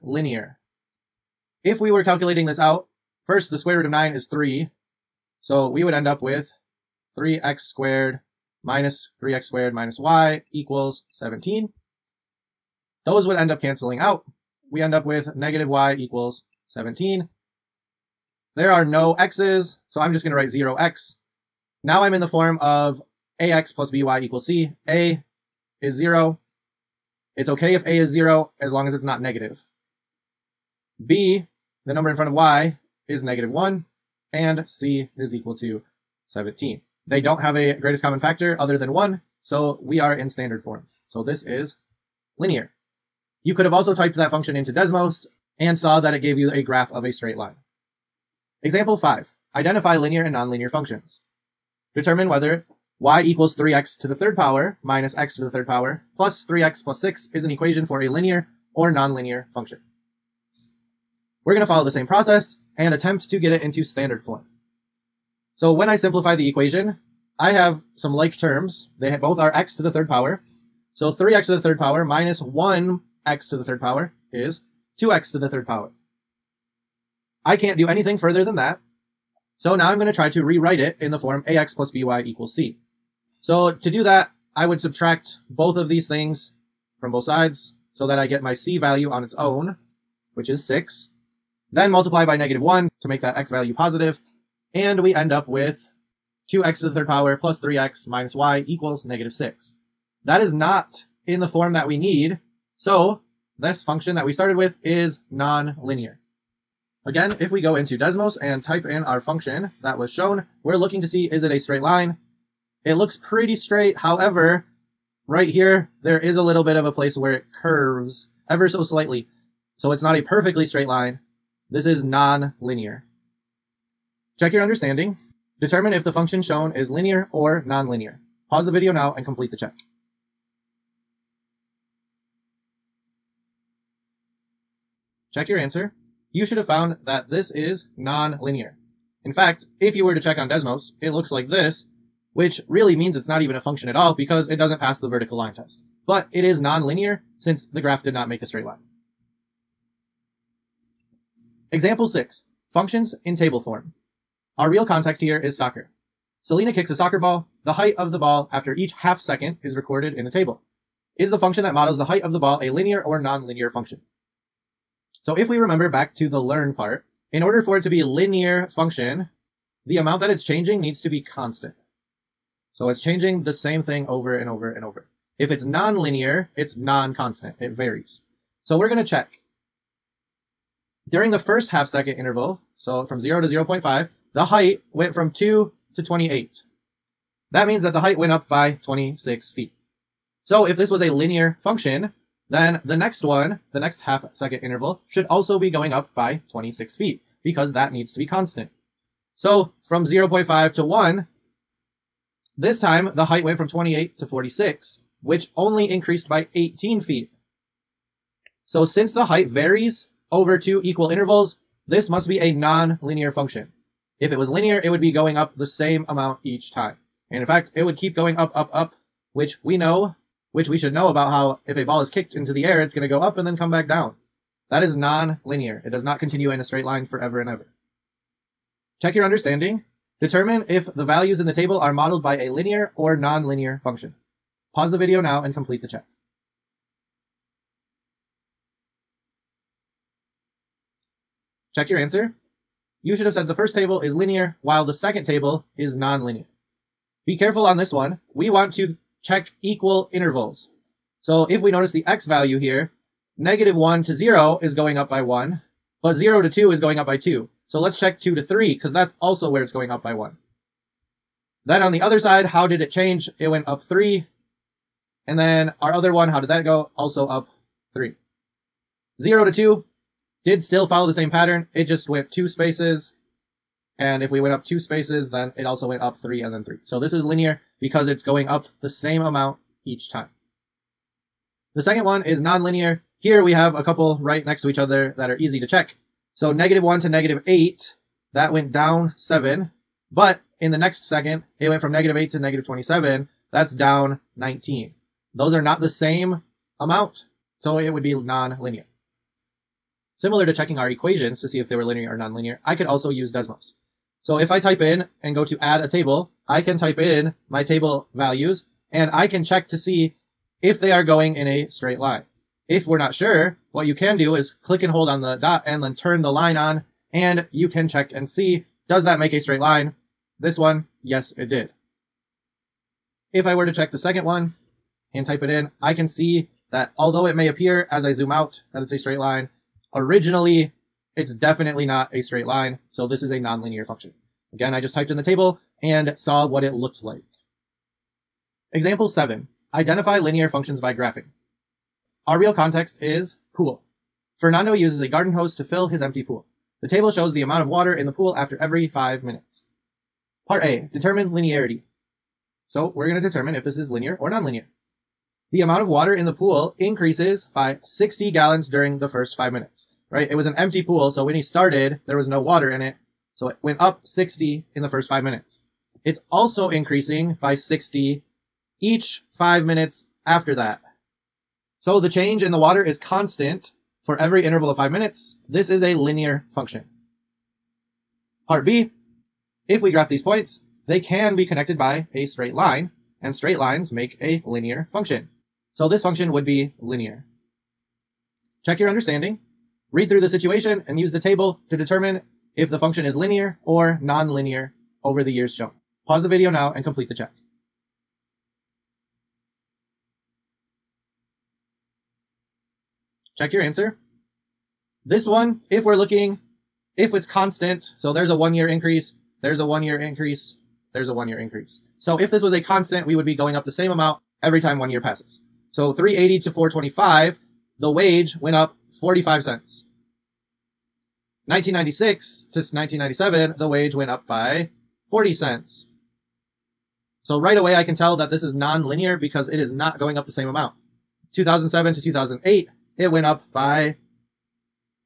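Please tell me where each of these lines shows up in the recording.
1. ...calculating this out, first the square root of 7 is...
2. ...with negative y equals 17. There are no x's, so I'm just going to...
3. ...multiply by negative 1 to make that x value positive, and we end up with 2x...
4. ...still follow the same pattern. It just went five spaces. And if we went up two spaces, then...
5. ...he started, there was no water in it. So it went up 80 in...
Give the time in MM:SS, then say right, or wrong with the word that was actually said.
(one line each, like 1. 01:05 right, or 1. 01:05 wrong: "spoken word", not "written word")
1. 00:02 wrong: "9", not "7"
2. 00:15 right
3. 01:31 right
4. 04:30 wrong: "two", not "five"
5. 06:01 wrong: "60", not "80".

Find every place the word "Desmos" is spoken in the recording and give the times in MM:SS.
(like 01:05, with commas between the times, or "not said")
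00:44, 01:47, 02:20, 05:03.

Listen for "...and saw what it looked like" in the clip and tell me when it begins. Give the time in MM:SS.
05:35.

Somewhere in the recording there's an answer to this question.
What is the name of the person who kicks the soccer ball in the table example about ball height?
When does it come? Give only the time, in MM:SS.
02:36.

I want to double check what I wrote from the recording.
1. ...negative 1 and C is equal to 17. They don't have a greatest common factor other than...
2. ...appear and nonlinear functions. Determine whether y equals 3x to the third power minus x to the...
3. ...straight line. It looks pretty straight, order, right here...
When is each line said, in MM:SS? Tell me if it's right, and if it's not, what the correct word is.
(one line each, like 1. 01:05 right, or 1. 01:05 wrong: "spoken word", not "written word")
1. 00:33 right
2. 00:49 wrong: "linear", not "appear"
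3. 01:51 wrong: "however", not "order".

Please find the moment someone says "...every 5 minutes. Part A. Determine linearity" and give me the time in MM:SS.
05:48.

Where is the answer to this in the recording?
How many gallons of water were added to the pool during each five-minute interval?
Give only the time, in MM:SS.
05:57.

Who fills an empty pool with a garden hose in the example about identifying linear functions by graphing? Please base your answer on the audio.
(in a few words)
Fernando.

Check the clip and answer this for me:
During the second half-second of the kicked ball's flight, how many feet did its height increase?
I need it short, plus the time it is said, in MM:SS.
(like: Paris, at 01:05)
18 feet, at 03:26.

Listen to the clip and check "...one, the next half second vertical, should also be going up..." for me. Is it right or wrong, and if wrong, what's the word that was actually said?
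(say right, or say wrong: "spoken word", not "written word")
wrong: "interval", not "vertical".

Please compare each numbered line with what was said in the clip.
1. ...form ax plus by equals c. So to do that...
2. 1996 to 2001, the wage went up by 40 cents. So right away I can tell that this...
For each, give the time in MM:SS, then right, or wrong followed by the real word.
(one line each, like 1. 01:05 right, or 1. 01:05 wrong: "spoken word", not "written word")
1. 01:21 right
2. 07:01 wrong: "1997", not "2001".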